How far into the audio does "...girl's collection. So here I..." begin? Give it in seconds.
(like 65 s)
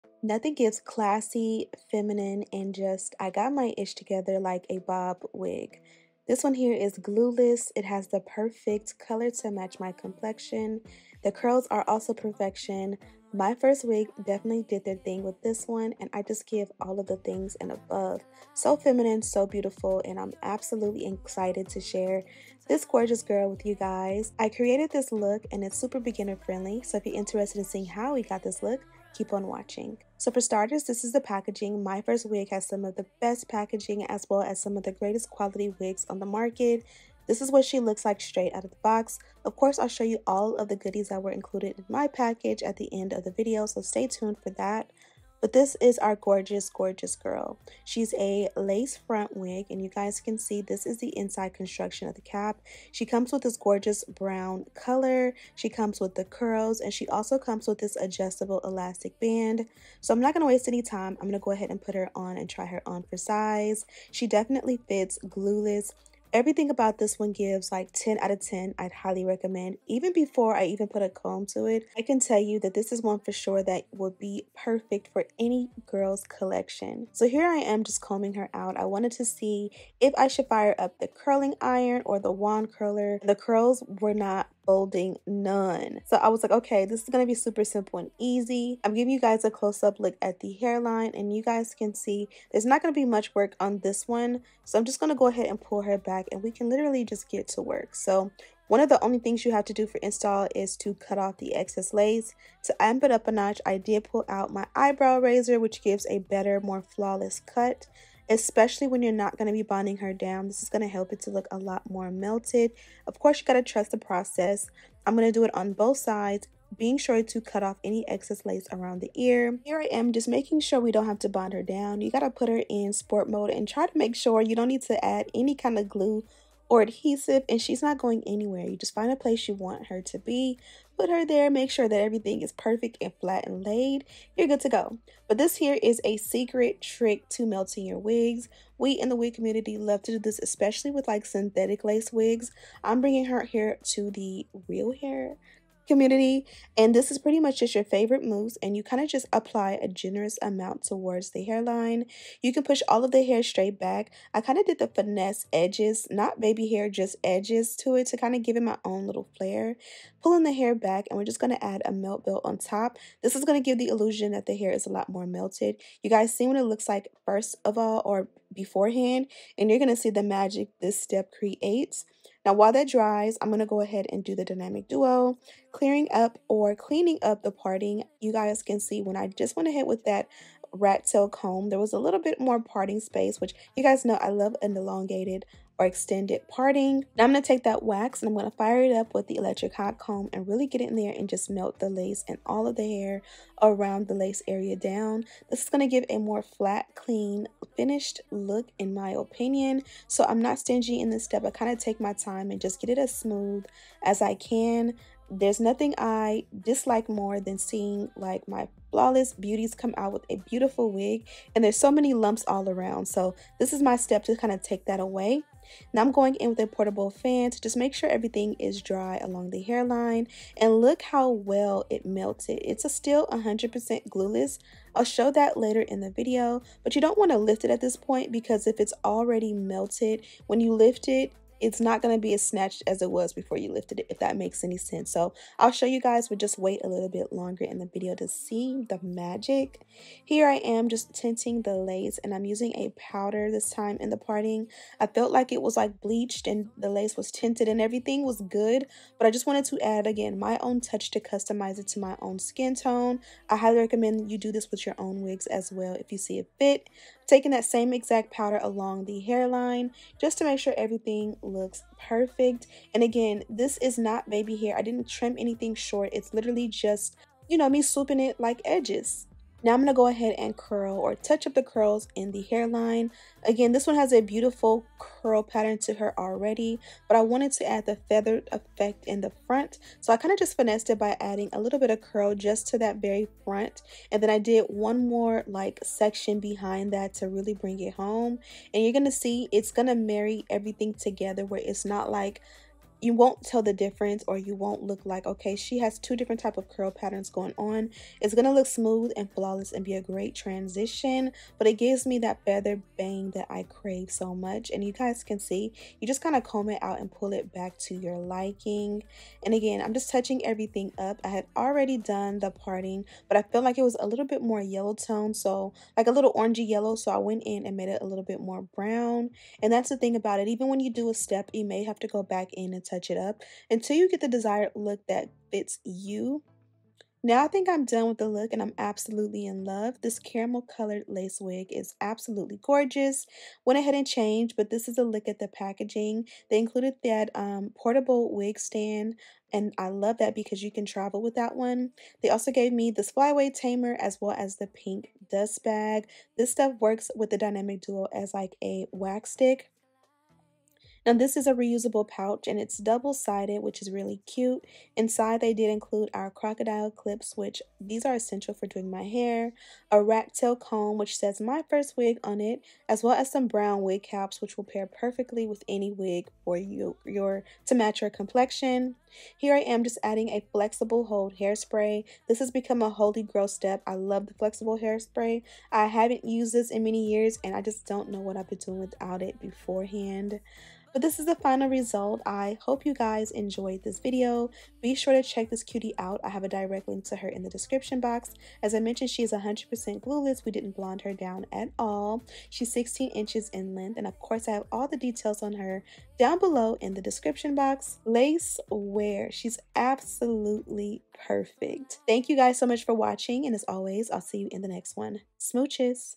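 75 s.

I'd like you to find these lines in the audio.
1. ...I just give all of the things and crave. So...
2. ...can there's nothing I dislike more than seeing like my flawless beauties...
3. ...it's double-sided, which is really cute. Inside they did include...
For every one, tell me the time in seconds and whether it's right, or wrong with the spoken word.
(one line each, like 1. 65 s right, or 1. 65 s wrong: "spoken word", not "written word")
1. 16 s wrong: "above", not "crave"
2. 204 s right
3. 352 s right.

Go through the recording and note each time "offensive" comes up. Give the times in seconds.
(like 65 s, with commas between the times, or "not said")
not said.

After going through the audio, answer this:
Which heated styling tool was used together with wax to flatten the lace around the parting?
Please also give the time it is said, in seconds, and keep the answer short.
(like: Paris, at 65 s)
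electric hot comb, at 189 s.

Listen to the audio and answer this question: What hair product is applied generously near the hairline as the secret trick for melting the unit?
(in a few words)
mousse.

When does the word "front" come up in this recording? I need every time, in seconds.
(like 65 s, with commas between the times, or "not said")
48 s, 279 s, 283 s.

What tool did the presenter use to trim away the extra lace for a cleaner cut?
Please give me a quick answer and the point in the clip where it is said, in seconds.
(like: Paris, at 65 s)
eyebrow razor, at 104 s.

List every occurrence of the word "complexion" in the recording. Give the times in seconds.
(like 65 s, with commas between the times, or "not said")
9 s, 368 s.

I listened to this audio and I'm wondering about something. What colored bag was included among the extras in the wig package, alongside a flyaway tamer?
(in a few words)
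pink dust bag.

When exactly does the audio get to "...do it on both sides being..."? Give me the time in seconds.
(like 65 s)
115 s.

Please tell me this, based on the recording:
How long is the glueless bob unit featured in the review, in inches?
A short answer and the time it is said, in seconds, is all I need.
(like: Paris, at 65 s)
16, at 392 s.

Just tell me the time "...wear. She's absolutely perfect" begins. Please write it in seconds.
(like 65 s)
398 s.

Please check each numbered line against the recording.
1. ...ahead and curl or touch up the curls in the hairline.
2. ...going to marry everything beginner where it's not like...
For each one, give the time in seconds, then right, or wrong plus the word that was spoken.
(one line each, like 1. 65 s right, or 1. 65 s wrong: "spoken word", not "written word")
1. 270 s right
2. 289 s wrong: "together", not "beginner".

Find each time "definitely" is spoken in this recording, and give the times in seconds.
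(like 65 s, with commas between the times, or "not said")
14 s, 64 s.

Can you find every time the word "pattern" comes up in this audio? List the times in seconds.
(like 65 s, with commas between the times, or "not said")
275 s, 296 s.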